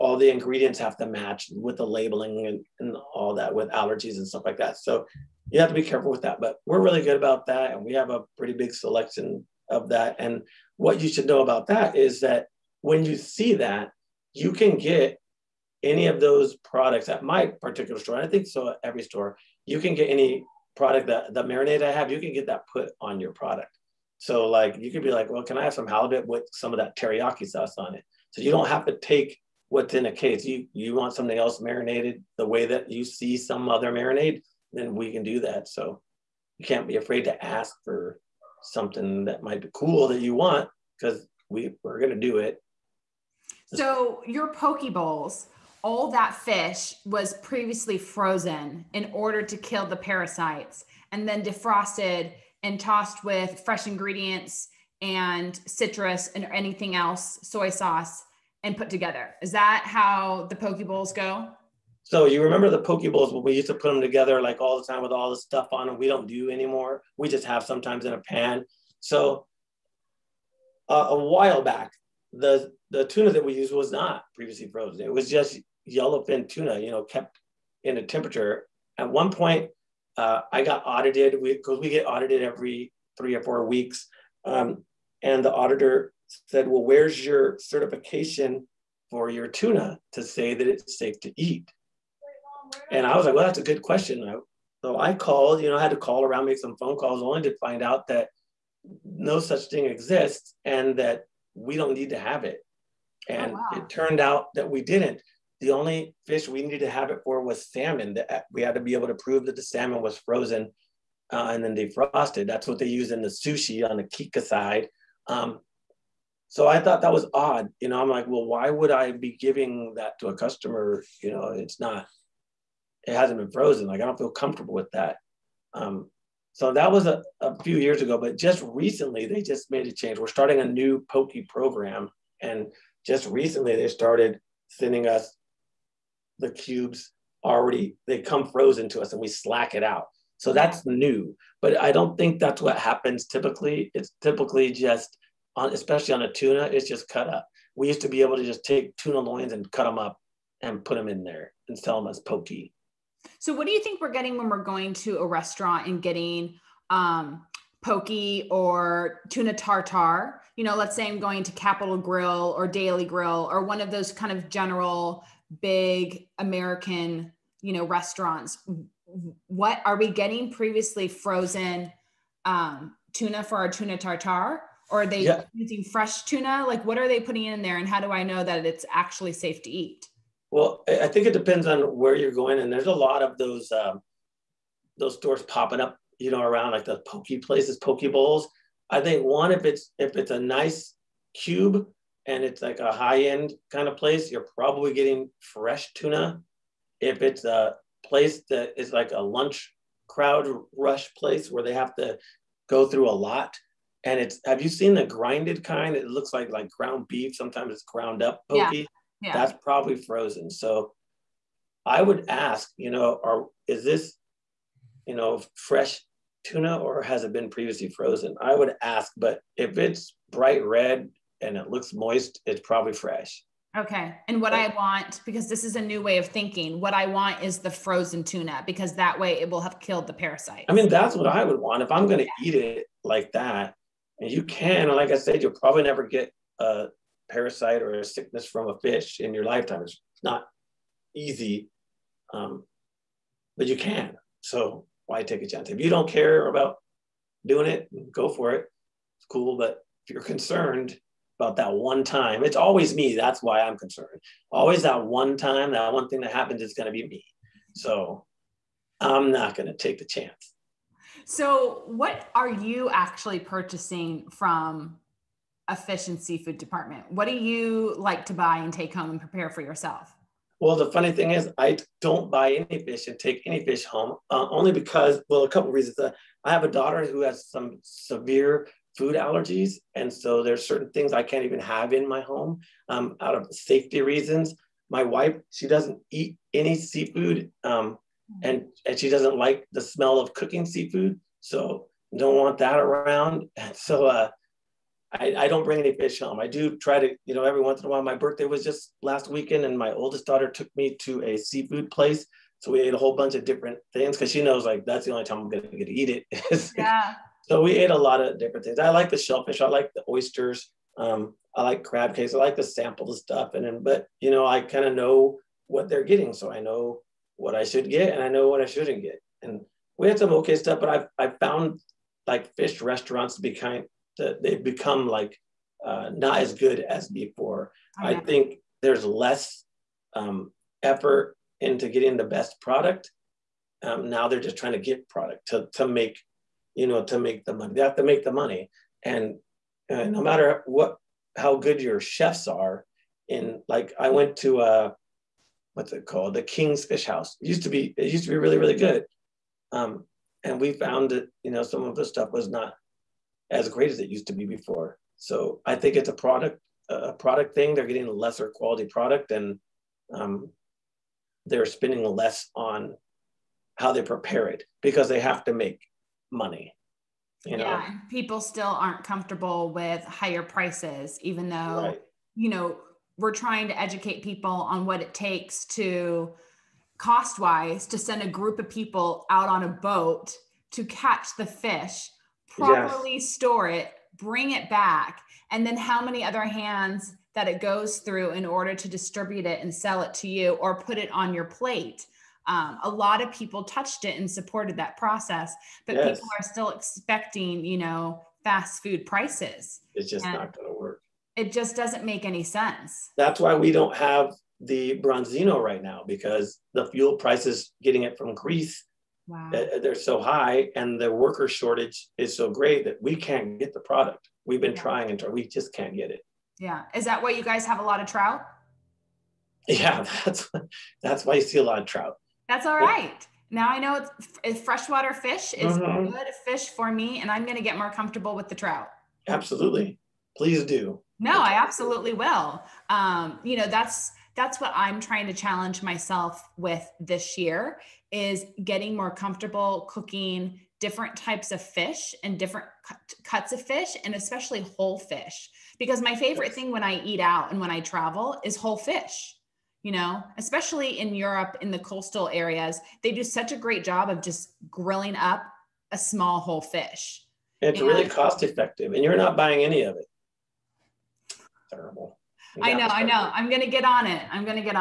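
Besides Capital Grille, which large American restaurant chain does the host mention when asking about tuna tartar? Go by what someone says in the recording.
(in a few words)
Daily Grill.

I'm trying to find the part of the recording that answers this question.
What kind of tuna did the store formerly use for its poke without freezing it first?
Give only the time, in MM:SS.
01:15.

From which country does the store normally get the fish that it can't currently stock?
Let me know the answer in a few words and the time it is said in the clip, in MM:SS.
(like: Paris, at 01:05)
Greece, at 06:48.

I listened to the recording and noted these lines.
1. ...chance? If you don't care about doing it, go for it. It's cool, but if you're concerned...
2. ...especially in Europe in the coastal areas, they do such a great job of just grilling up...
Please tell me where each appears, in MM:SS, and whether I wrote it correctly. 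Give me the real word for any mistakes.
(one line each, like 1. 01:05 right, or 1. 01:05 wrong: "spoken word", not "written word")
1. 04:05 right
2. 07:30 right.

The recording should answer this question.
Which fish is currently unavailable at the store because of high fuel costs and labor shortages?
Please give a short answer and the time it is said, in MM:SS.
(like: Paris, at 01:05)
branzino, at 06:45.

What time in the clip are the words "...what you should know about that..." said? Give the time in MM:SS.
00:10.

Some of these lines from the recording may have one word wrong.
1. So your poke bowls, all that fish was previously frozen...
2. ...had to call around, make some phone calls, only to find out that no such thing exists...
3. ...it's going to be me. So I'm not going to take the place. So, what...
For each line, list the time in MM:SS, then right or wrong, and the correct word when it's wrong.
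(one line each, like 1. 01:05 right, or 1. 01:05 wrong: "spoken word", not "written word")
1. 00:43 right
2. 01:35 right
3. 04:16 wrong: "chance", not "place".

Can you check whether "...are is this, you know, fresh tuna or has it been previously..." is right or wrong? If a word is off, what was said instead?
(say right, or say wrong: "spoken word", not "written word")
right.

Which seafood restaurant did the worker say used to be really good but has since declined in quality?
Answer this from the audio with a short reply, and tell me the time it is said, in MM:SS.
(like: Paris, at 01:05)
King's Fish House, at 05:46.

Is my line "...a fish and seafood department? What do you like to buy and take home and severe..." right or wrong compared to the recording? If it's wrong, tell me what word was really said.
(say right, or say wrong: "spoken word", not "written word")
wrong: "prepare", not "severe".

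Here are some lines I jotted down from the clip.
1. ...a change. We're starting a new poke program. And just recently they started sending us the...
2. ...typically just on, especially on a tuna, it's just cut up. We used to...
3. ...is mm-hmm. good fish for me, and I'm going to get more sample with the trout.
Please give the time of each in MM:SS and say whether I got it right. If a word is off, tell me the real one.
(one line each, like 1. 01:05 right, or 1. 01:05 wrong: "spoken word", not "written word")
1. 02:09 right
2. 02:24 right
3. 07:05 wrong: "comfortable", not "sample".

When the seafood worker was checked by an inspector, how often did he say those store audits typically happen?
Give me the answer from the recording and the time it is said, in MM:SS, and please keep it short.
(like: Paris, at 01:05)
every 3 or 4 weeks, at 01:22.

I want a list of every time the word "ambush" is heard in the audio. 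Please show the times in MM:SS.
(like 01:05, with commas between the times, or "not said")
not said.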